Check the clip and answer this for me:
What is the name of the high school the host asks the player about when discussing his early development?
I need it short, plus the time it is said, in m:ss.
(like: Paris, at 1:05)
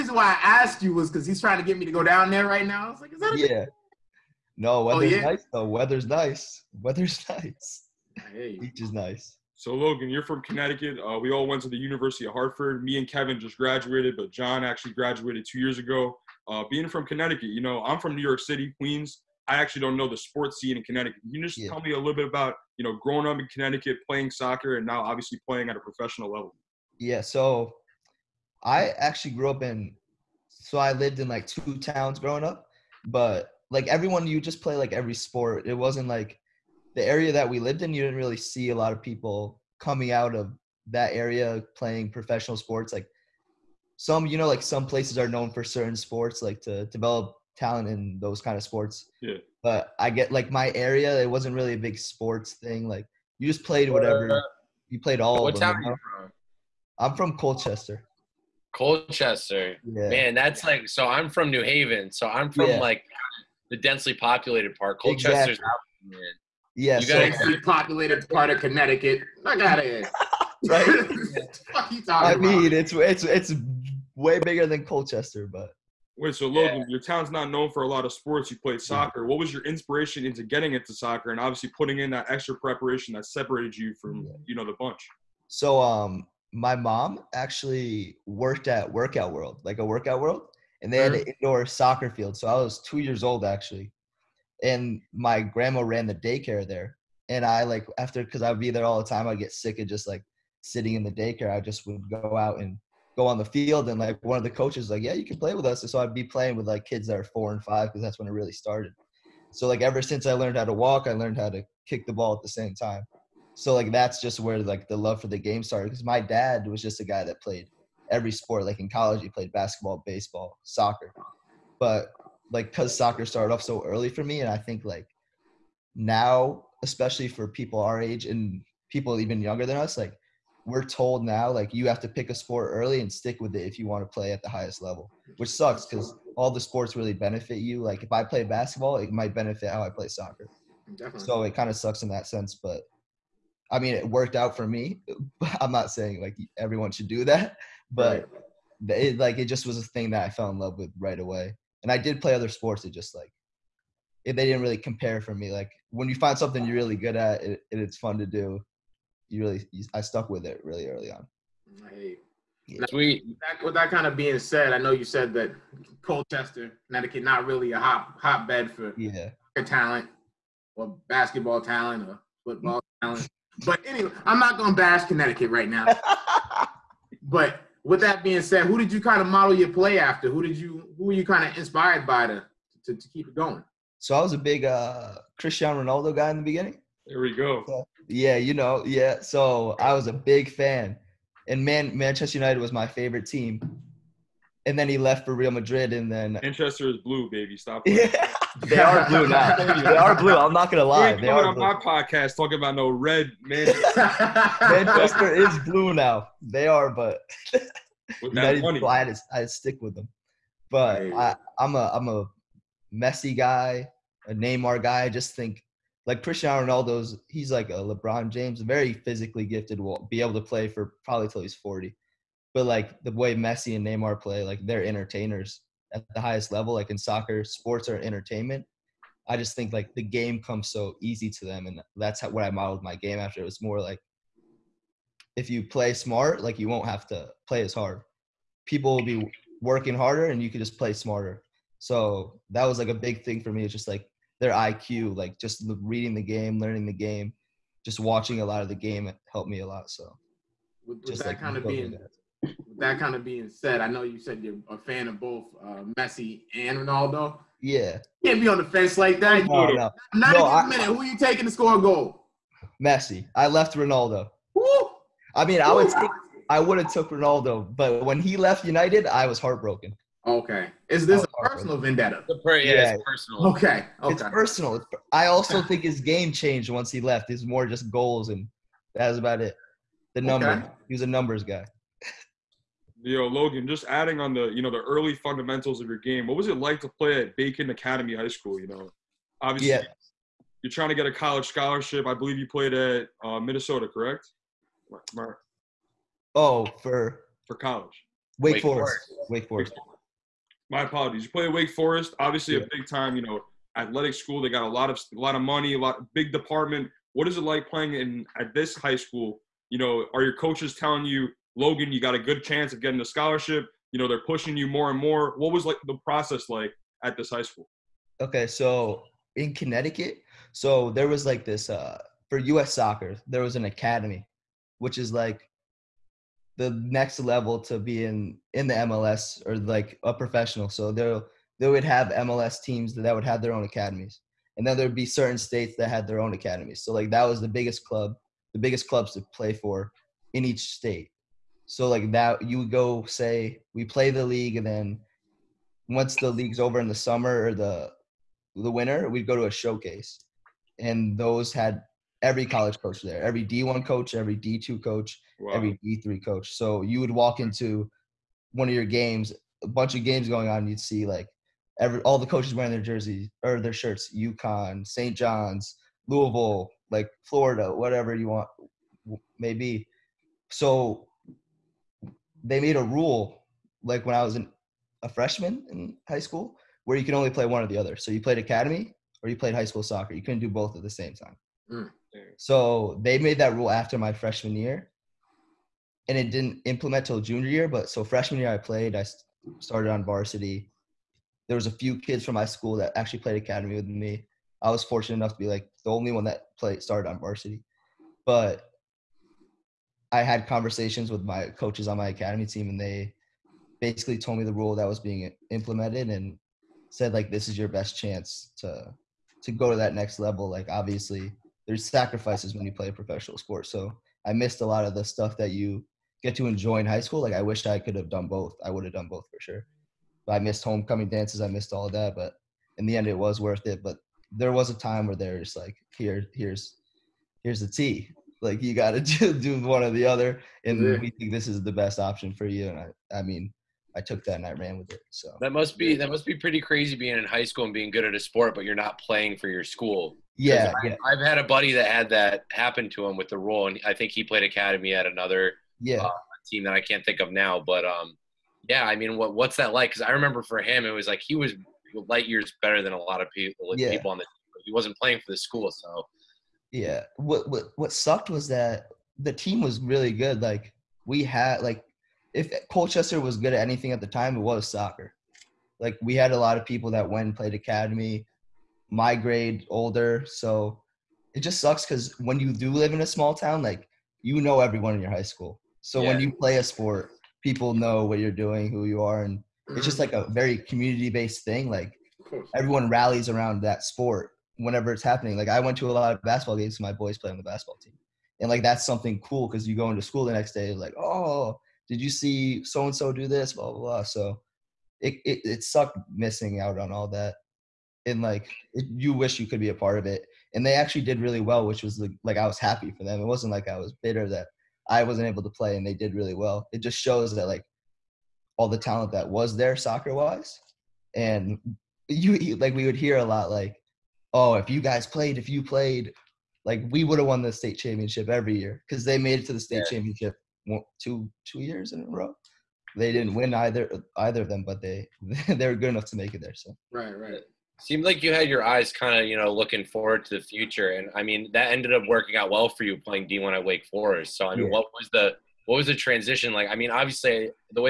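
Bacon Academy, at 4:47.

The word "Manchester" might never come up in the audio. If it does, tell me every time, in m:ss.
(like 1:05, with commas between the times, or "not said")
3:11, 3:16, 3:24.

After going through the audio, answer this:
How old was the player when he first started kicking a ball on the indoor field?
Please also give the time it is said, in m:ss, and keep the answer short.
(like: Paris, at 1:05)
2, at 1:32.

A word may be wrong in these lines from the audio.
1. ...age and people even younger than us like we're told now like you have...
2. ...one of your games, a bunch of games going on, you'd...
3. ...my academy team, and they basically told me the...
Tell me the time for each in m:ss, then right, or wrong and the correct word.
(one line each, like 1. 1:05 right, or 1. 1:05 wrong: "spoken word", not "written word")
1. 2:08 right
2. 5:58 right
3. 6:41 right.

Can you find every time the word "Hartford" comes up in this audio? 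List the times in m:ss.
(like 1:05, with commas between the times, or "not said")
0:12.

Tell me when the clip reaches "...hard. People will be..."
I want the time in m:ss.
3:57.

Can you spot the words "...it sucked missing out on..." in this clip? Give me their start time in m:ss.
8:15.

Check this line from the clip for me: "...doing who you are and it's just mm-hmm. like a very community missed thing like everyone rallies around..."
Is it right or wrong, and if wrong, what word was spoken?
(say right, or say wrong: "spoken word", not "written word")
wrong: "based", not "missed".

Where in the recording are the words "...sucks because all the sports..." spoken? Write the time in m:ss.
2:15.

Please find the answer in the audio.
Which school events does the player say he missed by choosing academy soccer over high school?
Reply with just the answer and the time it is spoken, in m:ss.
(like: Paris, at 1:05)
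homecoming dances, at 7:00.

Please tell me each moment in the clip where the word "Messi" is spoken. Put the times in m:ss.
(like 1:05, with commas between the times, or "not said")
3:32, 3:43, 4:15, 4:22.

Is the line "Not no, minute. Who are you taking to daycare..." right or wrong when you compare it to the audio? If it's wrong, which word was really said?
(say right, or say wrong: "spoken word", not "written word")
wrong: "score", not "daycare".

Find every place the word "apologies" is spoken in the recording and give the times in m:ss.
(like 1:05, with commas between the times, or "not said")
5:00.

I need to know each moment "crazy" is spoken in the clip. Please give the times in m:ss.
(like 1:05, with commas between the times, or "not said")
7:16.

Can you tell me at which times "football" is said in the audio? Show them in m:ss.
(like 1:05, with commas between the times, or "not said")
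2:52.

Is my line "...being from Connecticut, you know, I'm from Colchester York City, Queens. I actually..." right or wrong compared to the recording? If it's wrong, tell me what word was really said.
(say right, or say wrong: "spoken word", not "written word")
wrong: "New", not "Colchester".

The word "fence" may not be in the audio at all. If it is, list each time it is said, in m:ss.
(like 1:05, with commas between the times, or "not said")
4:18.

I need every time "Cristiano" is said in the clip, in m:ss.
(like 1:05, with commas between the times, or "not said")
3:05, 3:36.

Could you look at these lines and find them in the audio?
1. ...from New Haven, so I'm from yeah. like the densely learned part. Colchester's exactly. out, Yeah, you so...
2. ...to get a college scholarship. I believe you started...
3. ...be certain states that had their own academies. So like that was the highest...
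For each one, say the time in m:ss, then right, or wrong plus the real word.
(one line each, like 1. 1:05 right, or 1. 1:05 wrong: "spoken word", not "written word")
1. 1:01 wrong: "populated", not "learned"
2. 4:50 wrong: "played", not "started"
3. 5:34 wrong: "biggest", not "highest".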